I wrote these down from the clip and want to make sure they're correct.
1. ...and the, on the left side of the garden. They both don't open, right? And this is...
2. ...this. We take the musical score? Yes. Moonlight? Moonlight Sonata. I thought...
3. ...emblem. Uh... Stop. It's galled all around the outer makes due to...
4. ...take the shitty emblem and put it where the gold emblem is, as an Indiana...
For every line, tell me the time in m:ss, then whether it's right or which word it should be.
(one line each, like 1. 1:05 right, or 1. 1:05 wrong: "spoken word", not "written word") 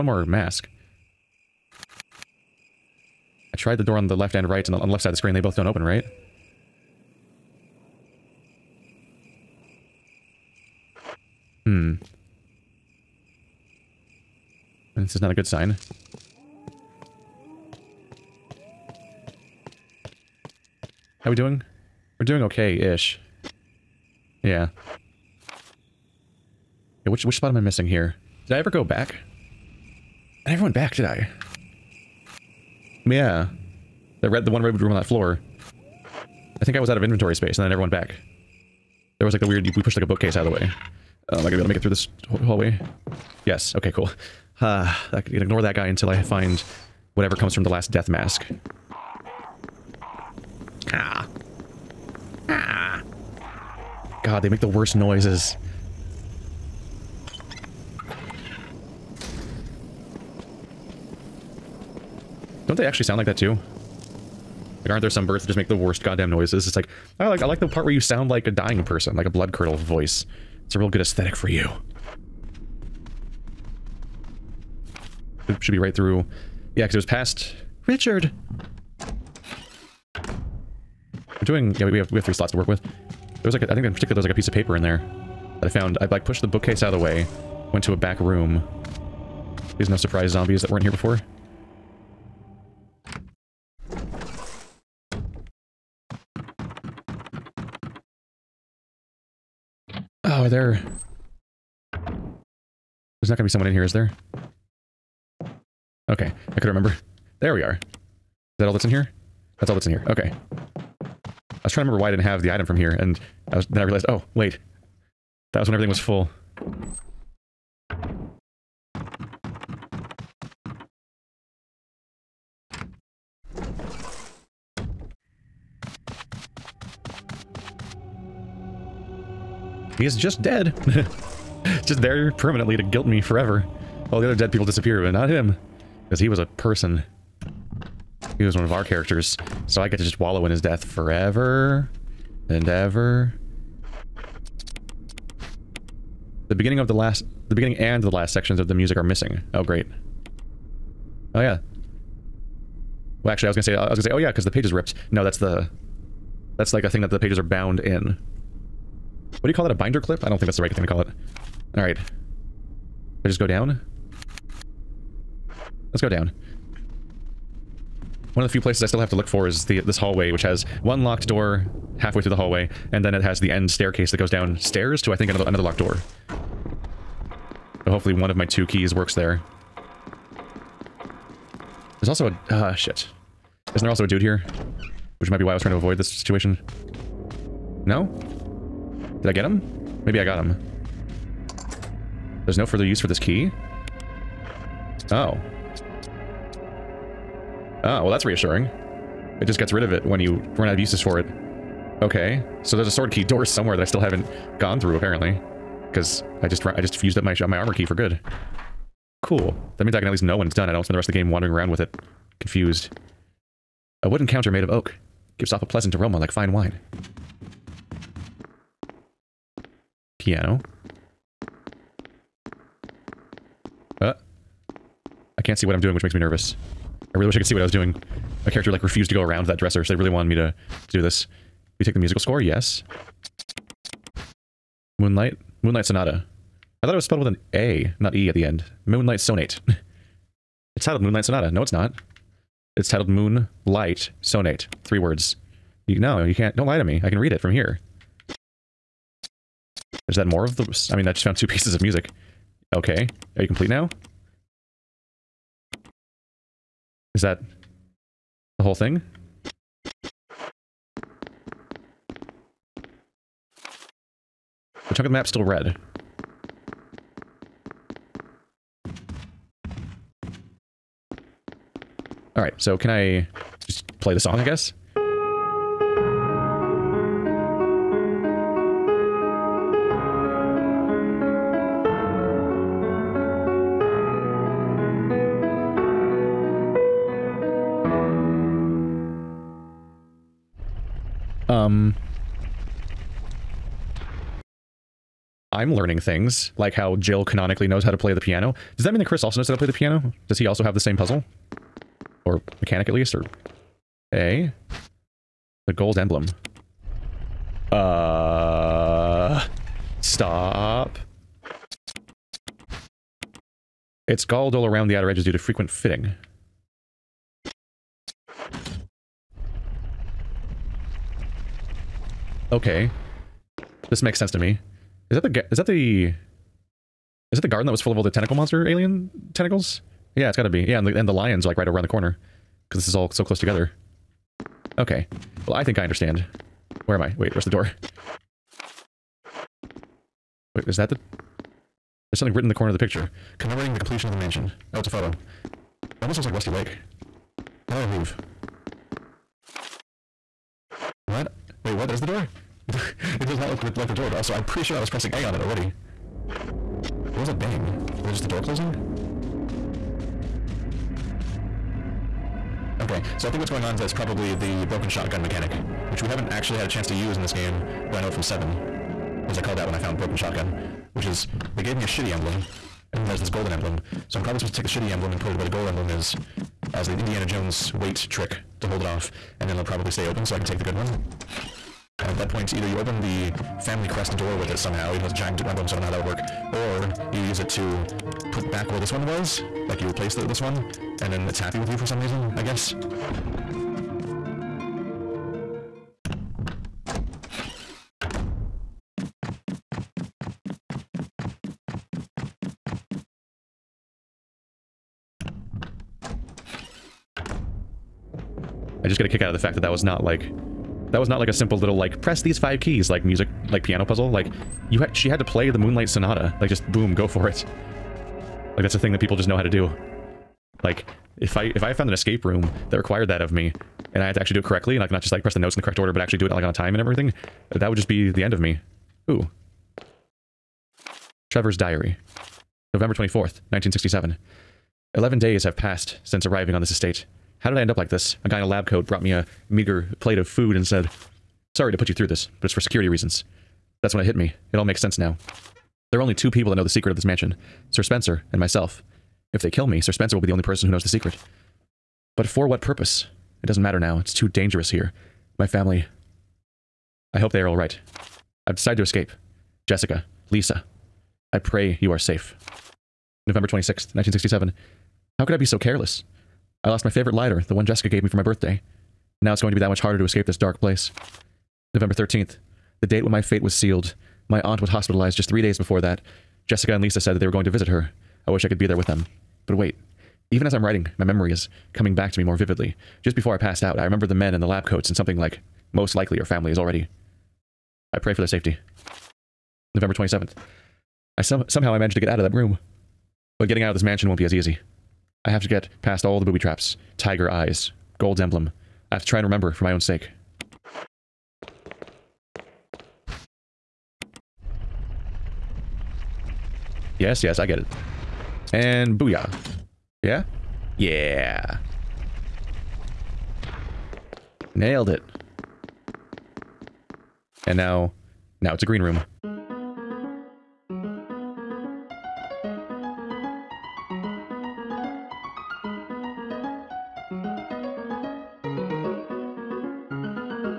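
1. 0:04 wrong: "screen", not "garden"
2. 3:51 right
3. 5:05 wrong: "edges", not "makes"
4. 6:14 right.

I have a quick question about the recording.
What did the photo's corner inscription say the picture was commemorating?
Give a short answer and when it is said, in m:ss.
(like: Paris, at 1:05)
completion of the mansion, at 5:43.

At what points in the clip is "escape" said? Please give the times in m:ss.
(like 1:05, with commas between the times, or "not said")
7:01, 7:38, 7:50.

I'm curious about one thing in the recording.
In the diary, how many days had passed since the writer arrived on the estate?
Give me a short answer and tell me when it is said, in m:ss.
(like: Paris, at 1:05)
11, at 7:14.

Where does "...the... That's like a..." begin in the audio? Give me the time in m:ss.
2:35.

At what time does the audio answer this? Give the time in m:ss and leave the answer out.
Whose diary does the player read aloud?
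7:11.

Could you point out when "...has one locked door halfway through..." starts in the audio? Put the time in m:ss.
2:50.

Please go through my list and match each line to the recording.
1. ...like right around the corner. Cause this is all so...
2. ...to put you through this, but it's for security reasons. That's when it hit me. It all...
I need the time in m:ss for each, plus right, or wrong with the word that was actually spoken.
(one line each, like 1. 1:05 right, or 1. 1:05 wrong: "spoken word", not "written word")
1. 5:31 right
2. 7:21 right.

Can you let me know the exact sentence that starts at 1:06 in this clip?
It's like, I like, I like the part where you sound like a dying person, like a blood curdle voice.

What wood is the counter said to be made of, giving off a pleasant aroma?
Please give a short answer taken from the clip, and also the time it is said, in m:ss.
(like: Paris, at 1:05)
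oak, at 3:34.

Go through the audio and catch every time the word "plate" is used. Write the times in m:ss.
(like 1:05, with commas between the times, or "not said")
7:20.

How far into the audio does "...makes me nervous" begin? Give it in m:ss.
3:46.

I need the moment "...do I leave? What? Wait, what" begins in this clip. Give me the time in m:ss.
5:47.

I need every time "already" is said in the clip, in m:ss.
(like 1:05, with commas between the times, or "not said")
5:55, 8:06.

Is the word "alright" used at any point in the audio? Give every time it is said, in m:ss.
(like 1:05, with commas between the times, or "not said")
2:41, 7:37.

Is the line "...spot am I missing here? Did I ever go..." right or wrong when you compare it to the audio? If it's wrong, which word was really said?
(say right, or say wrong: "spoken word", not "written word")
right.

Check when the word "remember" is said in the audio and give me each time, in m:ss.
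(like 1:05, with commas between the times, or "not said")
1:46, 1:51, 8:03, 8:19.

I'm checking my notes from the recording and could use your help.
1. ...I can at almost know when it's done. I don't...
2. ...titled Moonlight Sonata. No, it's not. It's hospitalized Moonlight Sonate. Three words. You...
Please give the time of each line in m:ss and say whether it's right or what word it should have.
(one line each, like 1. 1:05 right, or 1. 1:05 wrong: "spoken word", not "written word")
1. 3:29 wrong: "least", not "almost"
2. 4:00 wrong: "titled", not "hospitalized".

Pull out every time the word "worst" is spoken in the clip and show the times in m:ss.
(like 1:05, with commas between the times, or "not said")
0:54, 1:05.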